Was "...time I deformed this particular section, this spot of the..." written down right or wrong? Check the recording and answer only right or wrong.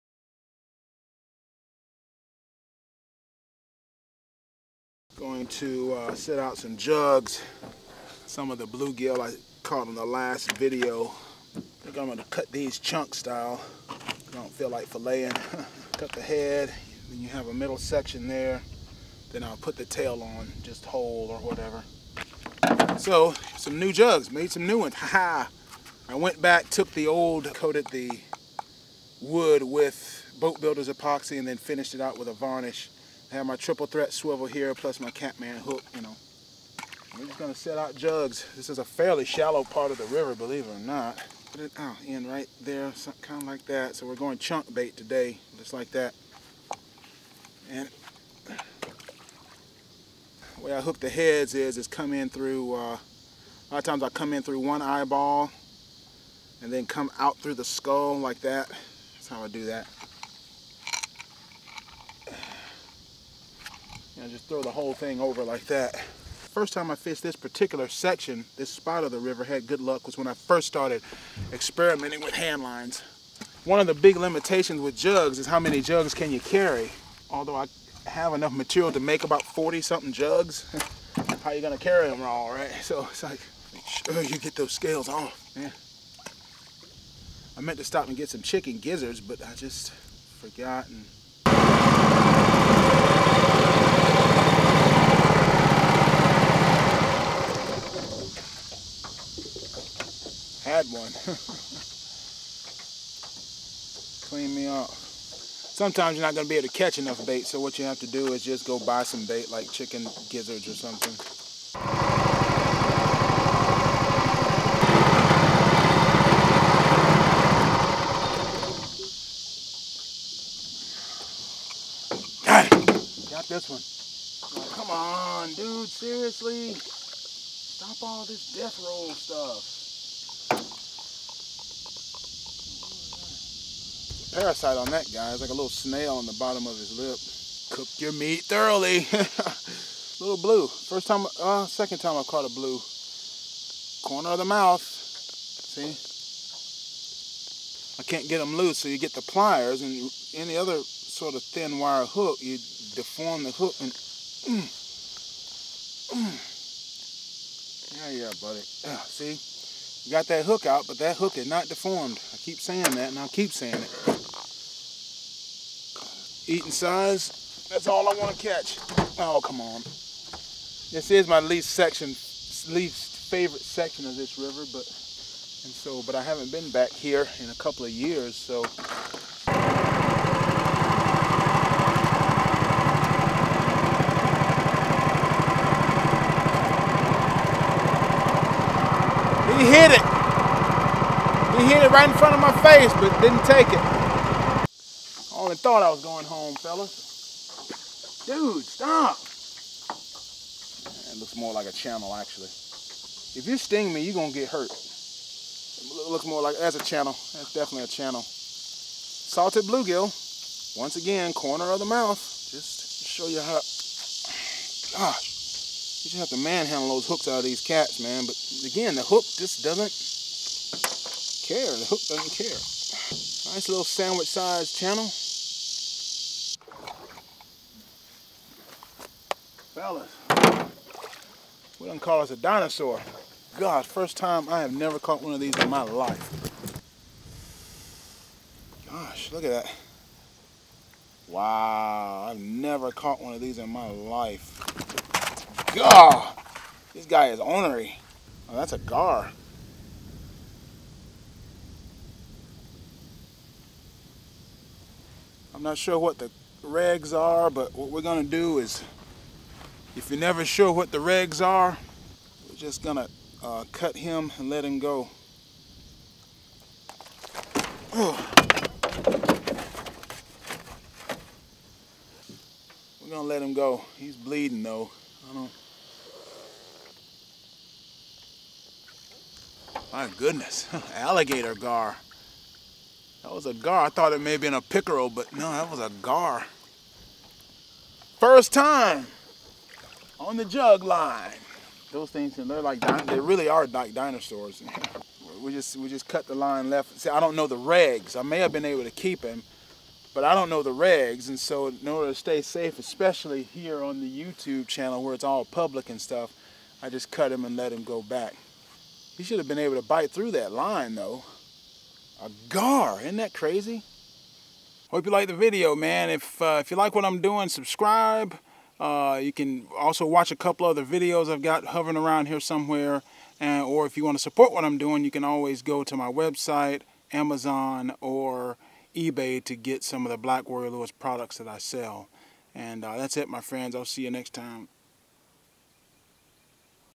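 wrong.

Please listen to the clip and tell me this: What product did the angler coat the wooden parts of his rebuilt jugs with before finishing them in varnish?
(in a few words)
boat builder's epoxy.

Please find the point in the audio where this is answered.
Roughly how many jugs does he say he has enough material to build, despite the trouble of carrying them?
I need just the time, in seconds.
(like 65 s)
79 s.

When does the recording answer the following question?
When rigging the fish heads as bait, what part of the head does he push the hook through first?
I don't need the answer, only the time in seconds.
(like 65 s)
54 s.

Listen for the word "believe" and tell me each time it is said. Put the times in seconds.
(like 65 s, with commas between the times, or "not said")
40 s.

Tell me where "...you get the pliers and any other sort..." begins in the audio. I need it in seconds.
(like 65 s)
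148 s.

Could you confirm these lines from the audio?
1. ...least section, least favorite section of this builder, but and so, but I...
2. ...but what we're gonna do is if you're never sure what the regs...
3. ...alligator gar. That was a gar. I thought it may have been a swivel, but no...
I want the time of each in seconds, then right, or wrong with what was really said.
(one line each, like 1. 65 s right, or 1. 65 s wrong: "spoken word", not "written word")
1. 171 s wrong: "river", not "builder"
2. 257 s right
3. 280 s wrong: "pickerel", not "swivel".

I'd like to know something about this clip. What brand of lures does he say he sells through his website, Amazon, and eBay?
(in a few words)
Black Warrior Lures.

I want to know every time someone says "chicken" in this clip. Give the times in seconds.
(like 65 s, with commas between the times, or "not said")
88 s, 109 s.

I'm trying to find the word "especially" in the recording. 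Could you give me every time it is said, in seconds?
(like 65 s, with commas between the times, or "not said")
302 s.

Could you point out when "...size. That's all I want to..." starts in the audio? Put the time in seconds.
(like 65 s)
166 s.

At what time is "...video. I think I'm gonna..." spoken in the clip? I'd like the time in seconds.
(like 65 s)
10 s.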